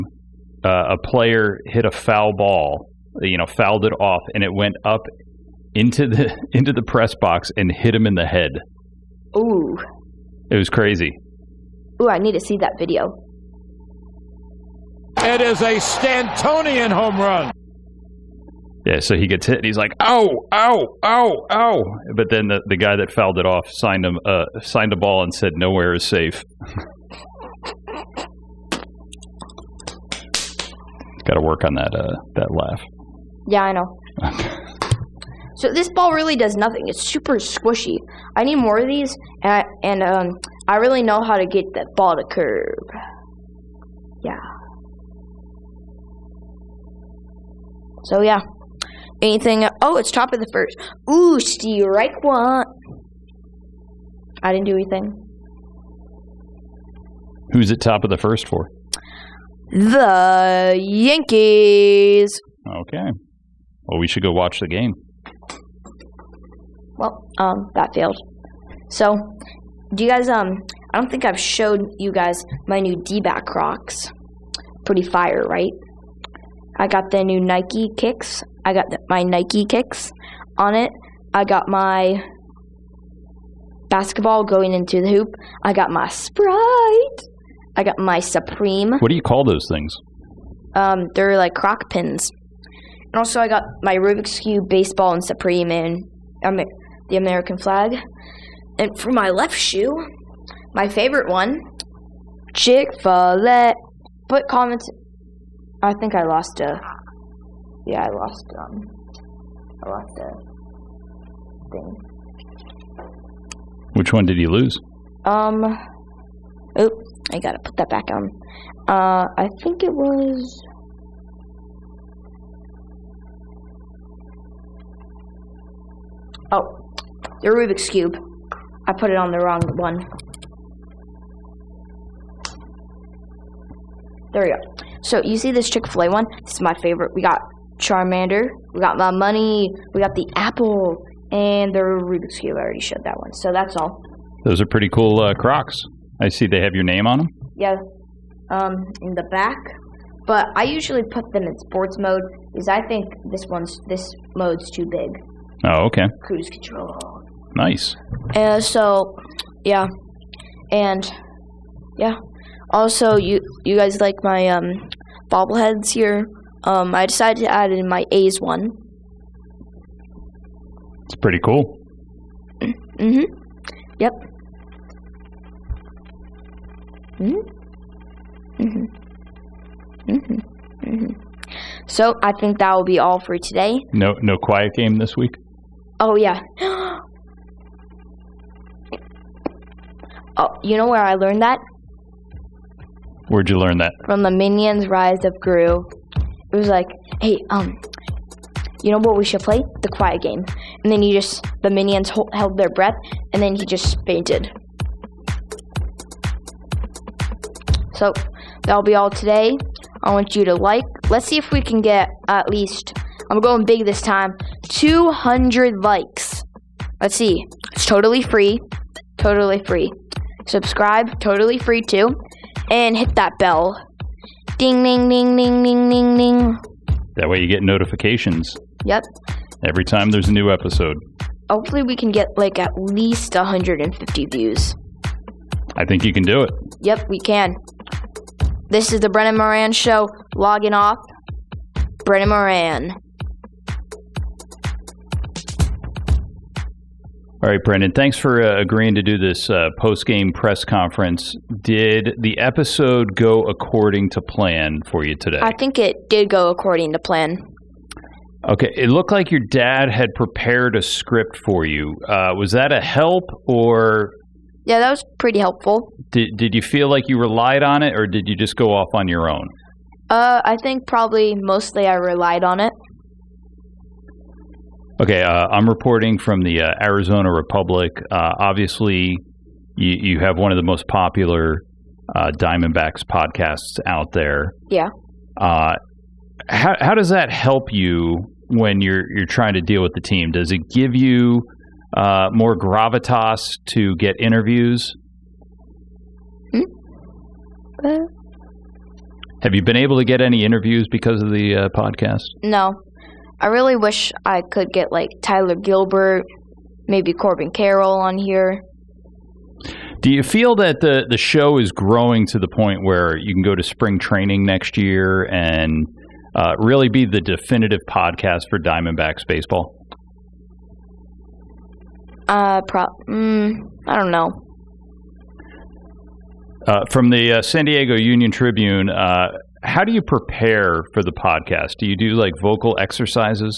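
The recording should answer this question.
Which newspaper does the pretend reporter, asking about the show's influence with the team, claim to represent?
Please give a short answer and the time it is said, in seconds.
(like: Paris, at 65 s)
Arizona Republic, at 276 s.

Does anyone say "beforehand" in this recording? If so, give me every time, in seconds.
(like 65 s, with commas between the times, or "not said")
not said.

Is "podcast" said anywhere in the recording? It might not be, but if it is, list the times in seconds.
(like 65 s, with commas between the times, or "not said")
283 s, 301 s, 317 s, 331 s.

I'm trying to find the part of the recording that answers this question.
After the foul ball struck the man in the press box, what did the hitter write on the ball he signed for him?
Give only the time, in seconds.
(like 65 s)
25 s.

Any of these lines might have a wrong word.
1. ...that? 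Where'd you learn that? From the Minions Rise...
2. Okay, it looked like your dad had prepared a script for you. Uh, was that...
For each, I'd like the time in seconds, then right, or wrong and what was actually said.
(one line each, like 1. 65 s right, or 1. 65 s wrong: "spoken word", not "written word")
1. 191 s right
2. 258 s right.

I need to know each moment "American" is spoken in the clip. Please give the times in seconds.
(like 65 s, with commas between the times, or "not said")
97 s.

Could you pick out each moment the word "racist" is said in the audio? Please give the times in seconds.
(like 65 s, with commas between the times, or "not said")
not said.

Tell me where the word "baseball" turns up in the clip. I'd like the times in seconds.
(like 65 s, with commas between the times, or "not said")
94 s, 319 s.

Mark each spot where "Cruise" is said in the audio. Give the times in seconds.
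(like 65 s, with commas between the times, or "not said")
156 s.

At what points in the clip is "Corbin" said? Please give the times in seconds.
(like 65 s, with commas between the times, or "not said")
307 s.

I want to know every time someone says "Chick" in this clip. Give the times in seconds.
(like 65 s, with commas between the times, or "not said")
102 s, 135 s.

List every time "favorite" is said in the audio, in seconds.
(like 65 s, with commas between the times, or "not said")
100 s, 136 s.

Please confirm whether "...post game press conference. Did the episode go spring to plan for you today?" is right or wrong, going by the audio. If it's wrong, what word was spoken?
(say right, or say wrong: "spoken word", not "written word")
wrong: "according", not "spring".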